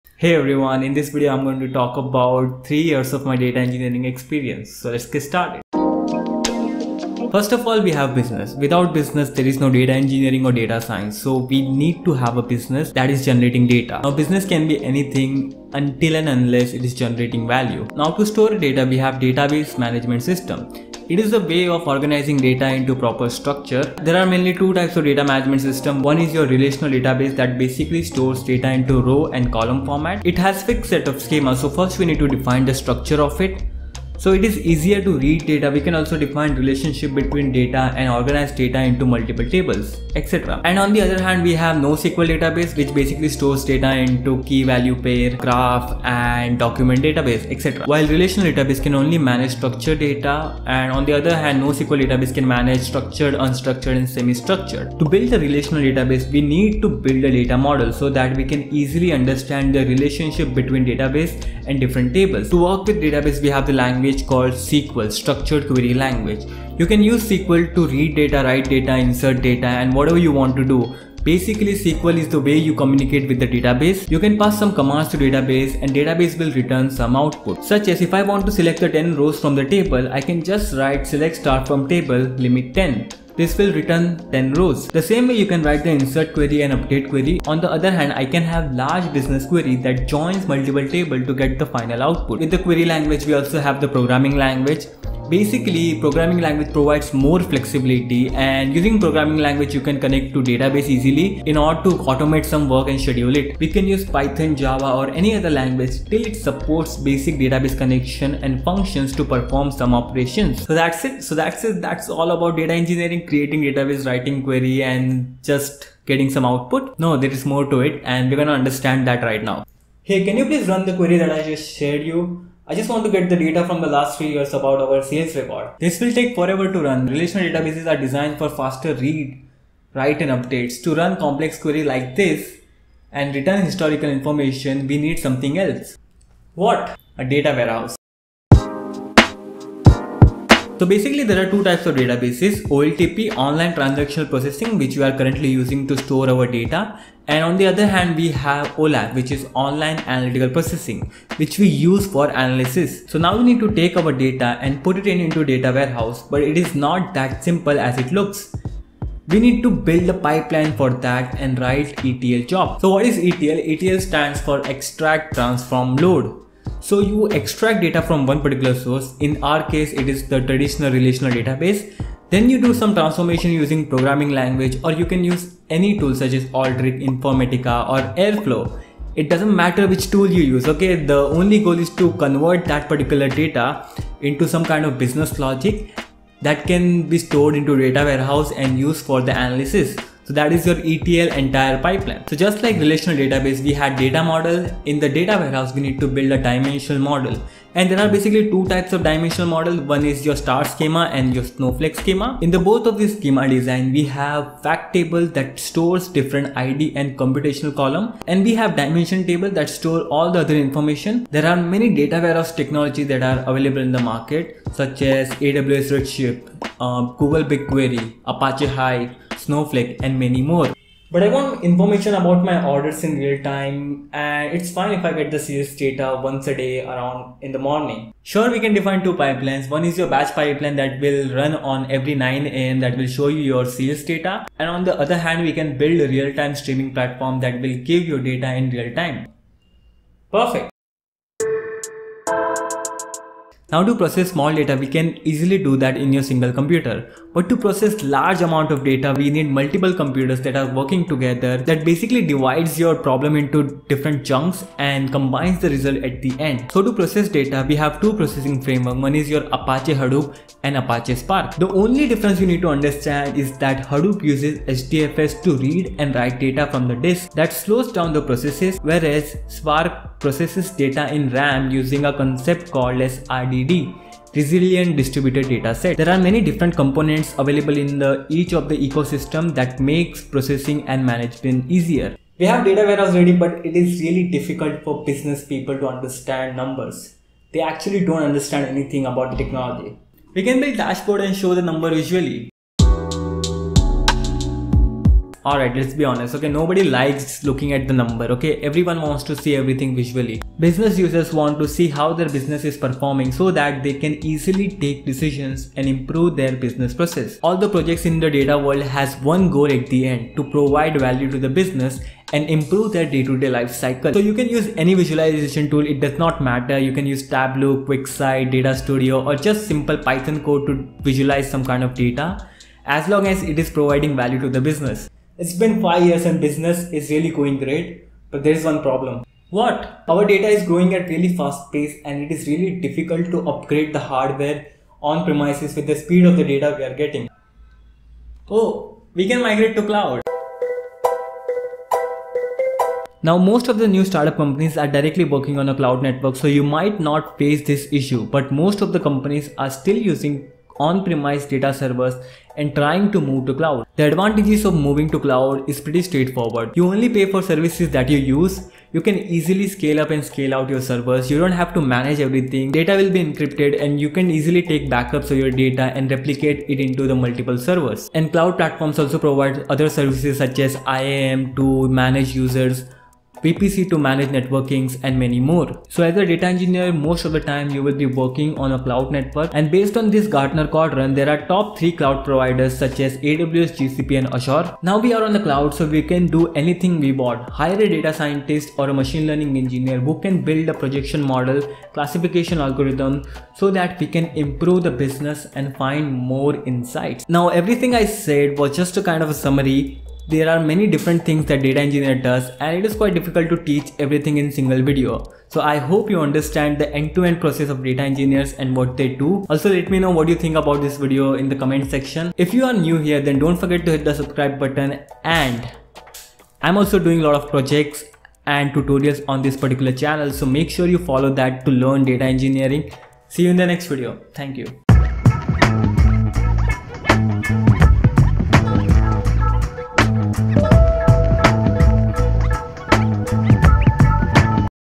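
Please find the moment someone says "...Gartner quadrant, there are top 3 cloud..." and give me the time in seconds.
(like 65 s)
380 s.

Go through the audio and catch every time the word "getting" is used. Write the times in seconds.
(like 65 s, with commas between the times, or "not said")
116 s, 336 s.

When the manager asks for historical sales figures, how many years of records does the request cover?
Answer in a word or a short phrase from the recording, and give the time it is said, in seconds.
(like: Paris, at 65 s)
3, at 123 s.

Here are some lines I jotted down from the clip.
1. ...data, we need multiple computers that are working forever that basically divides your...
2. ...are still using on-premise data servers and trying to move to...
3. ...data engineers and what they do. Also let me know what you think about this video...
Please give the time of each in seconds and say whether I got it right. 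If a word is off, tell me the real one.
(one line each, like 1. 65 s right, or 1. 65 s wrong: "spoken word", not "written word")
1. 248 s wrong: "together", not "forever"
2. 349 s right
3. 407 s right.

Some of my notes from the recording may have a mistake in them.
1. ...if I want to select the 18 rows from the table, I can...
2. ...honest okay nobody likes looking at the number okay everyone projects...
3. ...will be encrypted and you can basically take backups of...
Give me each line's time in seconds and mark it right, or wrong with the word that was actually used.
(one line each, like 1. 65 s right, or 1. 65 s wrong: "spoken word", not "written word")
1. 78 s wrong: "10", not "18"
2. 296 s wrong: "wants", not "projects"
3. 363 s wrong: "easily", not "basically".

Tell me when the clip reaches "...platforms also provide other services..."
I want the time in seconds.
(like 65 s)
368 s.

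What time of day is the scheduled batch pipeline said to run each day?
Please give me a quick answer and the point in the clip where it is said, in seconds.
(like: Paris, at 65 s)
9 am, at 232 s.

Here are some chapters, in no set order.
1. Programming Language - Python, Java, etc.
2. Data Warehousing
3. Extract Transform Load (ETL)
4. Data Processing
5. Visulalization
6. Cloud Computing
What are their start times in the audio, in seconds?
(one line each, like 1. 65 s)
1. 92 s
2. 119 s
3. 162 s
4. 220 s
5. 292 s
6. 328 s.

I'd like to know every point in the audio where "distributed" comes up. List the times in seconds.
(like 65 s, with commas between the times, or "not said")
274 s.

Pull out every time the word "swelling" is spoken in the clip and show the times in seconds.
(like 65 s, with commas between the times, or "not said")
not said.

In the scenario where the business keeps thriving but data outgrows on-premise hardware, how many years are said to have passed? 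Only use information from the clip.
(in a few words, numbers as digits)
5.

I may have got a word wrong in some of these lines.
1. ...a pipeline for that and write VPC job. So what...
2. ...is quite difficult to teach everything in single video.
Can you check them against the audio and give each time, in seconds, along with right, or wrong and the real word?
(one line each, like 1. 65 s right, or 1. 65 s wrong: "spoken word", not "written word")
1. 160 s wrong: "ETL", not "VPC"
2. 402 s right.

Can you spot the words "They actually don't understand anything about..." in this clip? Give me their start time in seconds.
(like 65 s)
287 s.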